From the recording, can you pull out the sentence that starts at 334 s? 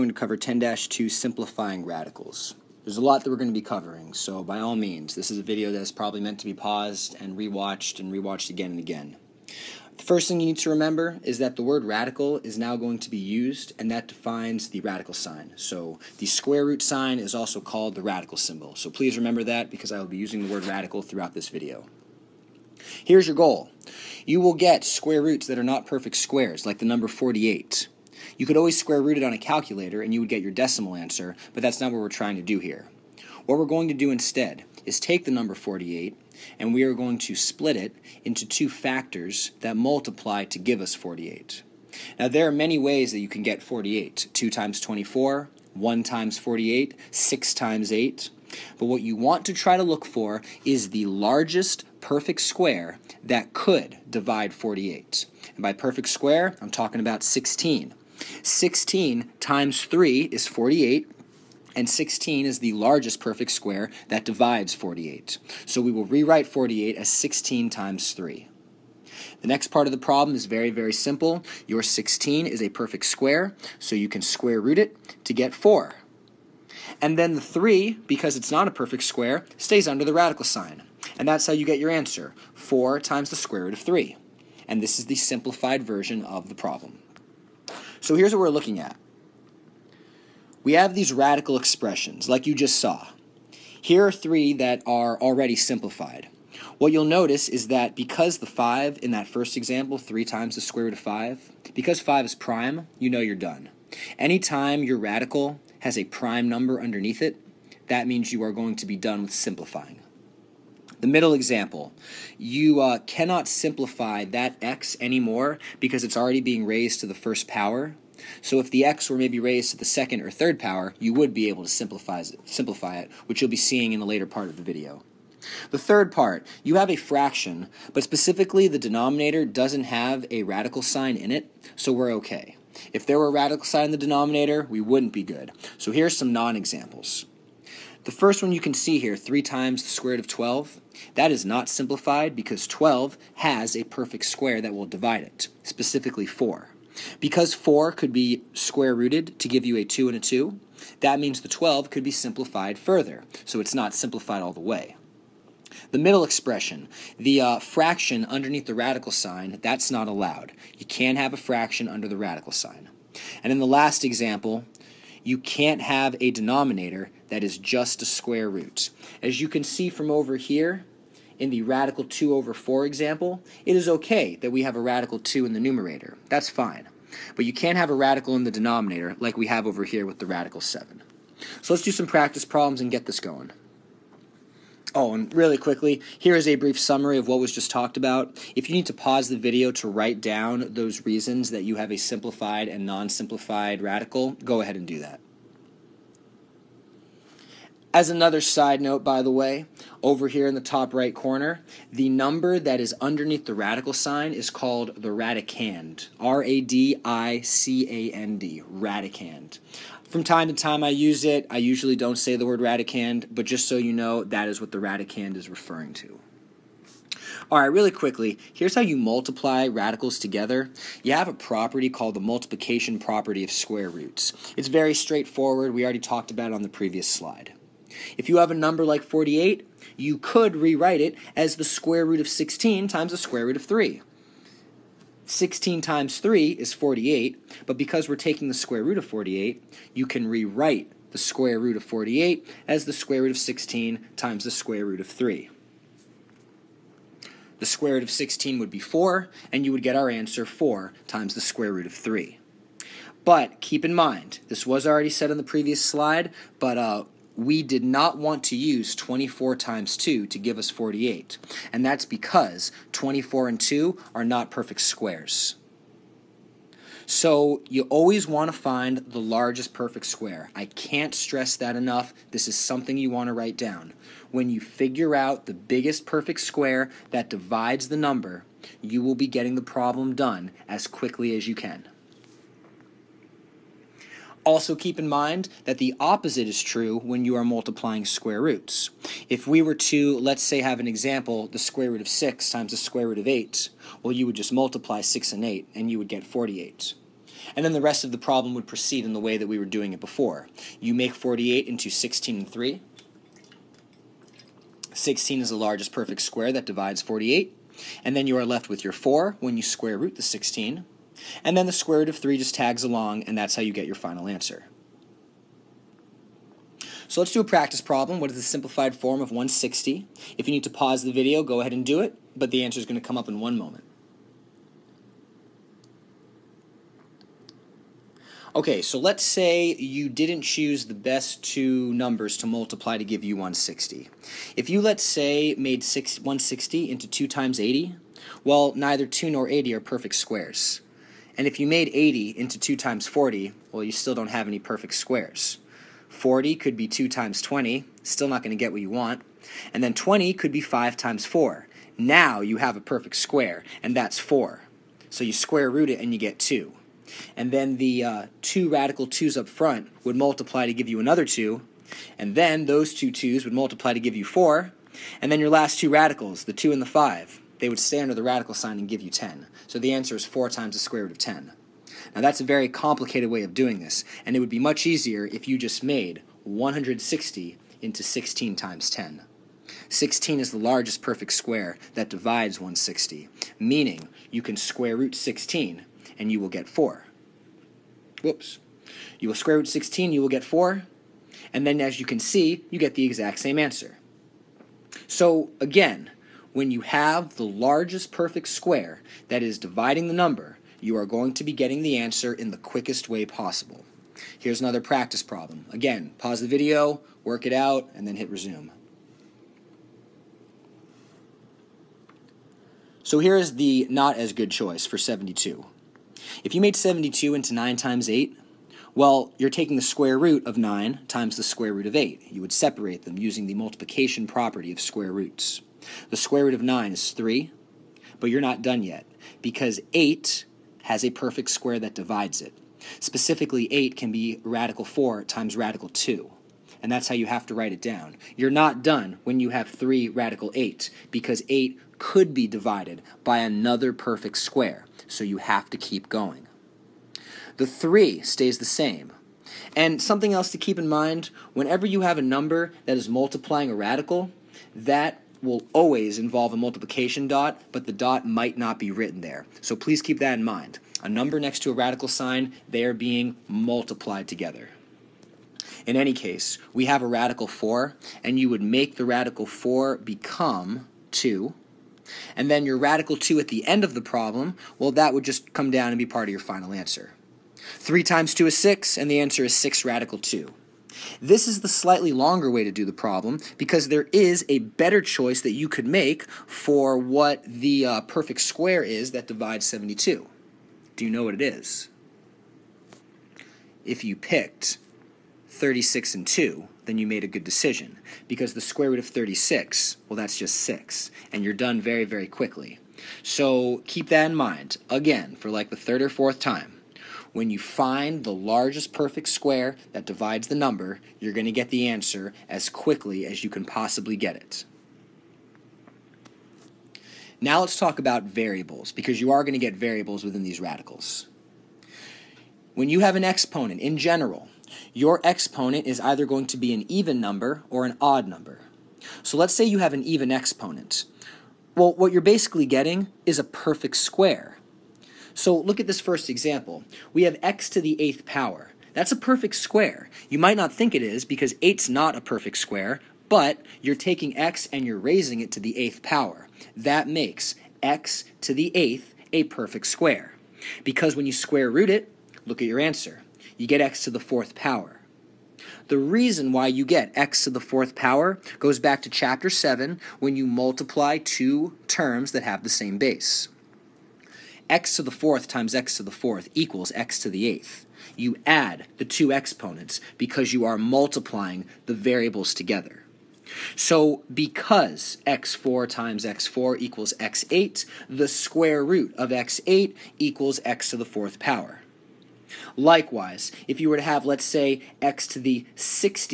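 If you, let's say, made 160 into 2 times 80, well, neither 2 nor 80 are perfect squares.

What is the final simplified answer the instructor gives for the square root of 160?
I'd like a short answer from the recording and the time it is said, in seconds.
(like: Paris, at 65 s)
4 times the square root of 10, at 370 s.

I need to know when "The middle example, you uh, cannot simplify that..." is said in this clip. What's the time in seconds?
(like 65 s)
111 s.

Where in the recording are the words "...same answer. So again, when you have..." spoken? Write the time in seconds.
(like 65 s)
393 s.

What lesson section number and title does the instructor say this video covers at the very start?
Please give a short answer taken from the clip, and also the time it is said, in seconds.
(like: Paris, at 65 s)
10-2 simplifying radicals, at 0 s.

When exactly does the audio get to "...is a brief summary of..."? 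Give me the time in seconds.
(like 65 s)
186 s.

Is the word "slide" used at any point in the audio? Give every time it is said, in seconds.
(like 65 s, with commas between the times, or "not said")
227 s, 255 s.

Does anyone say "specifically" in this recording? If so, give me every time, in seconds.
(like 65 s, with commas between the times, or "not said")
128 s, 145 s, 432 s.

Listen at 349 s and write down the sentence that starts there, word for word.
And then 20 could be 5 times 4.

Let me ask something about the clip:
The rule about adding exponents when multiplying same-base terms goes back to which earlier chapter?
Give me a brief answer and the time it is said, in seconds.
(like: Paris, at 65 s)
Chapter 7, at 559 s.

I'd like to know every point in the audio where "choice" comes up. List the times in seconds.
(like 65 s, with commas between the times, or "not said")
414 s, 485 s.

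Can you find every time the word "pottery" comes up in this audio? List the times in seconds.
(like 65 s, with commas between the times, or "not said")
not said.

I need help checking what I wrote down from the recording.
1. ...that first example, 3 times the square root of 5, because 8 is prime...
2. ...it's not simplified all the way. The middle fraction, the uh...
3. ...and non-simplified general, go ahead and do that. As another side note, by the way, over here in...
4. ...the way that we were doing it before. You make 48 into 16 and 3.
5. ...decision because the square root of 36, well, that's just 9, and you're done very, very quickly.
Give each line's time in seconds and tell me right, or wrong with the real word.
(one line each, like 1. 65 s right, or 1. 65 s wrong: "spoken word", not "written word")
1. 99 s wrong: "5", not "8"
2. 153 s wrong: "expression", not "fraction"
3. 192 s wrong: "radical", not "general"
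4. 299 s right
5. 497 s wrong: "6", not "9".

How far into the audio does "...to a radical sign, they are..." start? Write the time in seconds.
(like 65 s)
461 s.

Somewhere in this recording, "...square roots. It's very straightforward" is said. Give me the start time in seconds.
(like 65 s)
223 s.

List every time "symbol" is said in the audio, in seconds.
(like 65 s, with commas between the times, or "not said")
18 s.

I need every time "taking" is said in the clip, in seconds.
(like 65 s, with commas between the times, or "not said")
238 s, 419 s, 543 s.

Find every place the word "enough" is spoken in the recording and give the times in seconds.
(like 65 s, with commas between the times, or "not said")
271 s.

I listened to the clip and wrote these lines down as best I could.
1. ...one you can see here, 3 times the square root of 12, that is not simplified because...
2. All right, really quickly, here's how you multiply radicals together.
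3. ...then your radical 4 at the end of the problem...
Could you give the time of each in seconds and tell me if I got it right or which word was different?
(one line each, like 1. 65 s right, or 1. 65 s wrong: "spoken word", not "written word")
1. 138 s right
2. 217 s right
3. 472 s wrong: "2", not "4".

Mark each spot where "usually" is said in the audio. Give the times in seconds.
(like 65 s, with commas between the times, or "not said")
211 s.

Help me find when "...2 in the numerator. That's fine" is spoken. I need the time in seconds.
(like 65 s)
175 s.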